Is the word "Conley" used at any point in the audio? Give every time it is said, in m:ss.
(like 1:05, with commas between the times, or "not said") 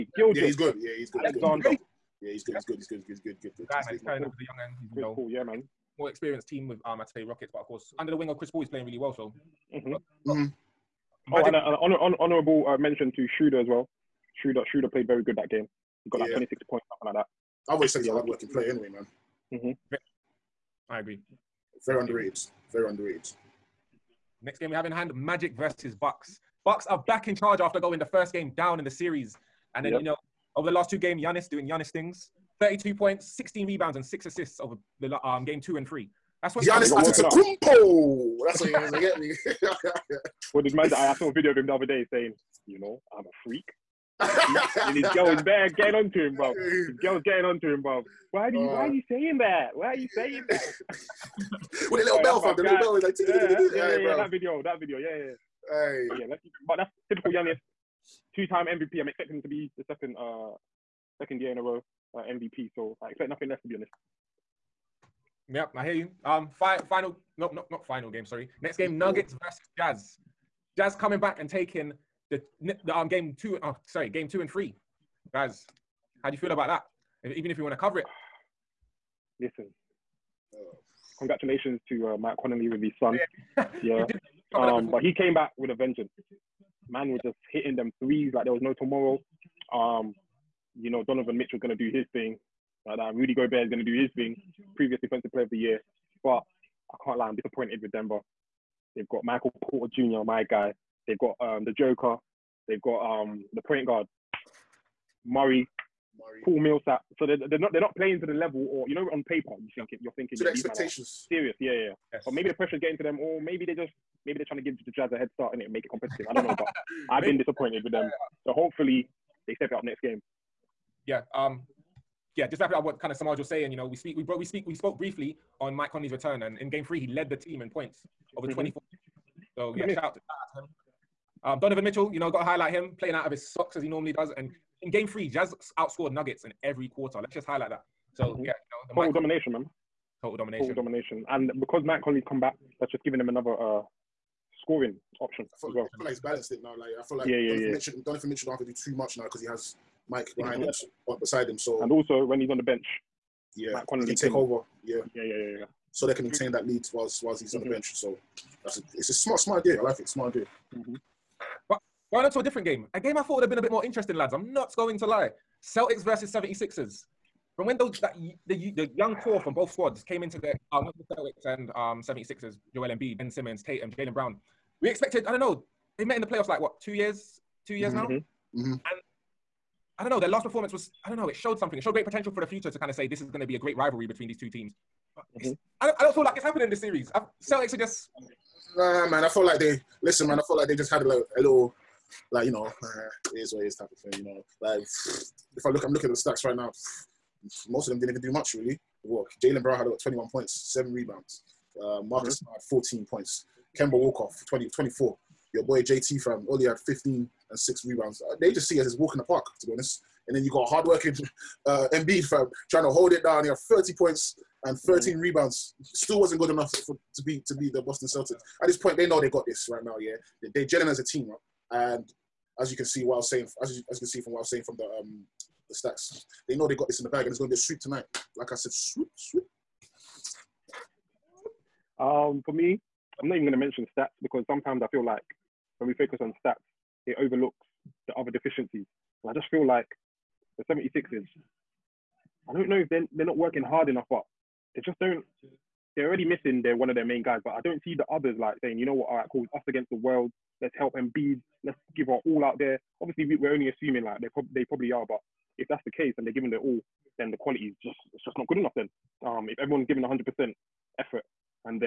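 1:22, 2:05, 2:22, 2:33.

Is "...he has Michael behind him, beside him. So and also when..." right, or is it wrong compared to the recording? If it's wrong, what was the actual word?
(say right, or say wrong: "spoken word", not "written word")
wrong: "Mike", not "Michael".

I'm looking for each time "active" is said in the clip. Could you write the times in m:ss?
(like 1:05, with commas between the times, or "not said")
not said.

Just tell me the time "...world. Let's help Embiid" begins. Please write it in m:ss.
4:09.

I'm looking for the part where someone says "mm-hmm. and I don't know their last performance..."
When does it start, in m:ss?
2:58.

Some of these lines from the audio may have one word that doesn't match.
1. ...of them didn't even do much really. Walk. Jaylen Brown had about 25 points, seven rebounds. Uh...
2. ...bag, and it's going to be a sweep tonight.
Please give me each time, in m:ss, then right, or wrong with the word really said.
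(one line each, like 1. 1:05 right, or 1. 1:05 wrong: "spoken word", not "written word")
1. 3:17 wrong: "21", not "25"
2. 3:47 right.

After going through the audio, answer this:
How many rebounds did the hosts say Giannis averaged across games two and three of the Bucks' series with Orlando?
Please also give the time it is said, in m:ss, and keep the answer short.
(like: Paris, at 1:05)
16, at 0:33.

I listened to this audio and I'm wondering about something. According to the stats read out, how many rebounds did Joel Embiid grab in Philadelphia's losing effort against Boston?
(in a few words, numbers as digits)
13.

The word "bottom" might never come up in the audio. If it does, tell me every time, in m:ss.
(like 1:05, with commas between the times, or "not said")
not said.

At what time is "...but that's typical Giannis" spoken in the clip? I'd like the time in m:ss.
0:56.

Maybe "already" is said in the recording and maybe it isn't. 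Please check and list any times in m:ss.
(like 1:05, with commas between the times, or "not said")
4:06.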